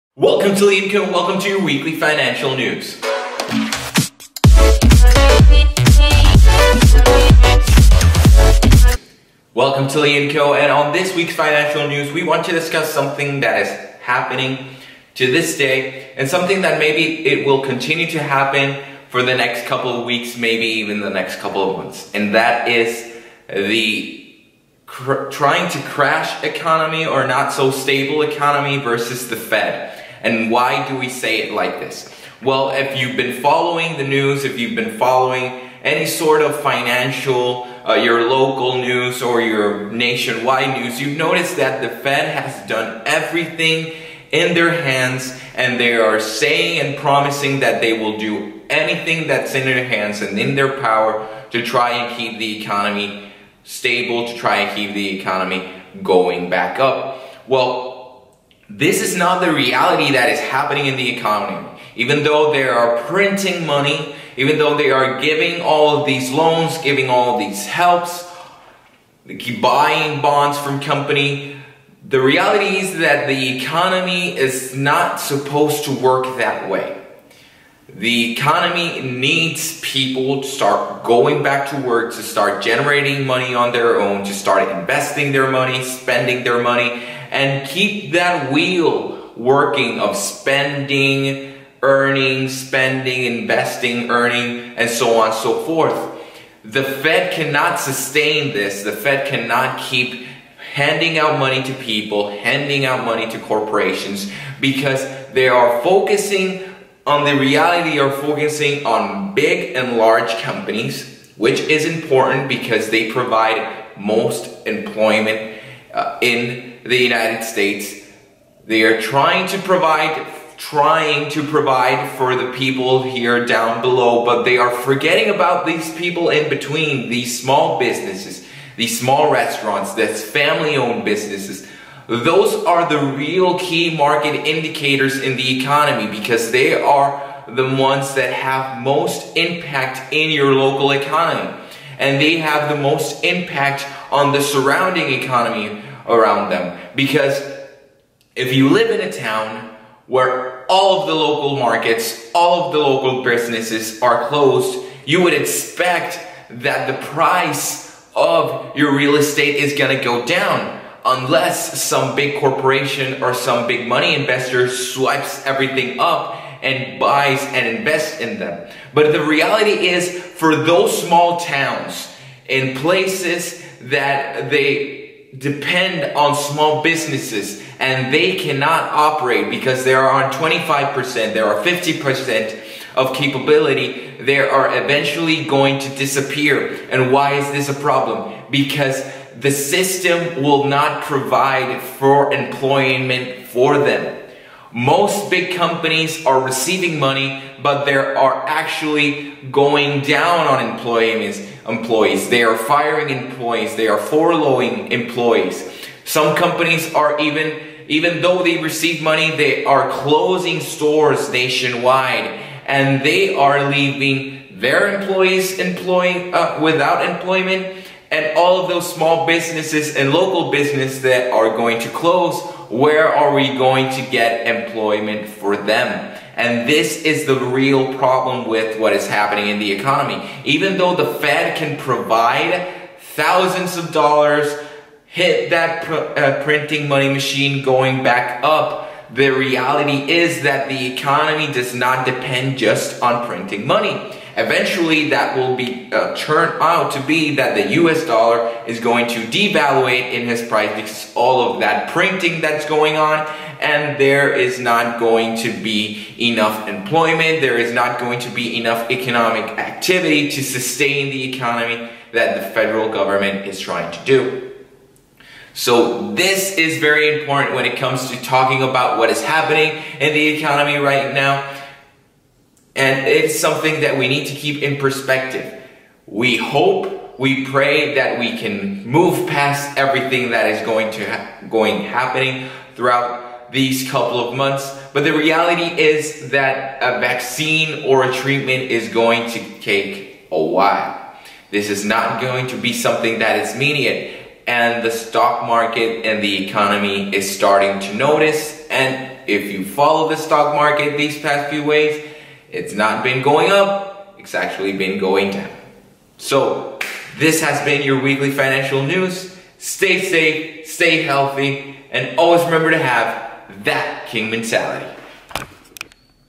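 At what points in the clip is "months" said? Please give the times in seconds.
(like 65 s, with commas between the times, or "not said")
21 s, 284 s.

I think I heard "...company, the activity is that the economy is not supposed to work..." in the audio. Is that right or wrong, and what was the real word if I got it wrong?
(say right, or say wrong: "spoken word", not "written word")
wrong: "reality", not "activity".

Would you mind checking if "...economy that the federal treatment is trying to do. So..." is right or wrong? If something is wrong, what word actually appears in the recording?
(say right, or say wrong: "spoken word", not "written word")
wrong: "government", not "treatment".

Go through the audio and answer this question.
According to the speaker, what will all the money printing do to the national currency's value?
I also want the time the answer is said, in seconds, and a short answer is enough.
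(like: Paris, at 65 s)
devaluate, at 249 s.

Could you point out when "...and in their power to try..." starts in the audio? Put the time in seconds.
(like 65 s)
50 s.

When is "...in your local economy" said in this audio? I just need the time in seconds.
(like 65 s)
140 s.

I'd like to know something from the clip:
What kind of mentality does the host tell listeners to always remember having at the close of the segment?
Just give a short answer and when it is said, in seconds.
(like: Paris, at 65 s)
king mentality, at 314 s.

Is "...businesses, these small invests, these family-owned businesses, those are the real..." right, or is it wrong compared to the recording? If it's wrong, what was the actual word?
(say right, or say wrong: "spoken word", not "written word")
wrong: "restaurants", not "invests".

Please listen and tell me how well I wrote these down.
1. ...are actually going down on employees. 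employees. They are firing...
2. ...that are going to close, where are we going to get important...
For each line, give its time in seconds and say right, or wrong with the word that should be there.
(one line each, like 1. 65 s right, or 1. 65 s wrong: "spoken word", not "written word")
1. 197 s right
2. 221 s wrong: "employment", not "important".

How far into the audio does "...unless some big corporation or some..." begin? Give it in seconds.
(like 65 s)
161 s.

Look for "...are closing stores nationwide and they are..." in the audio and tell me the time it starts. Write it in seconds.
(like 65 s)
209 s.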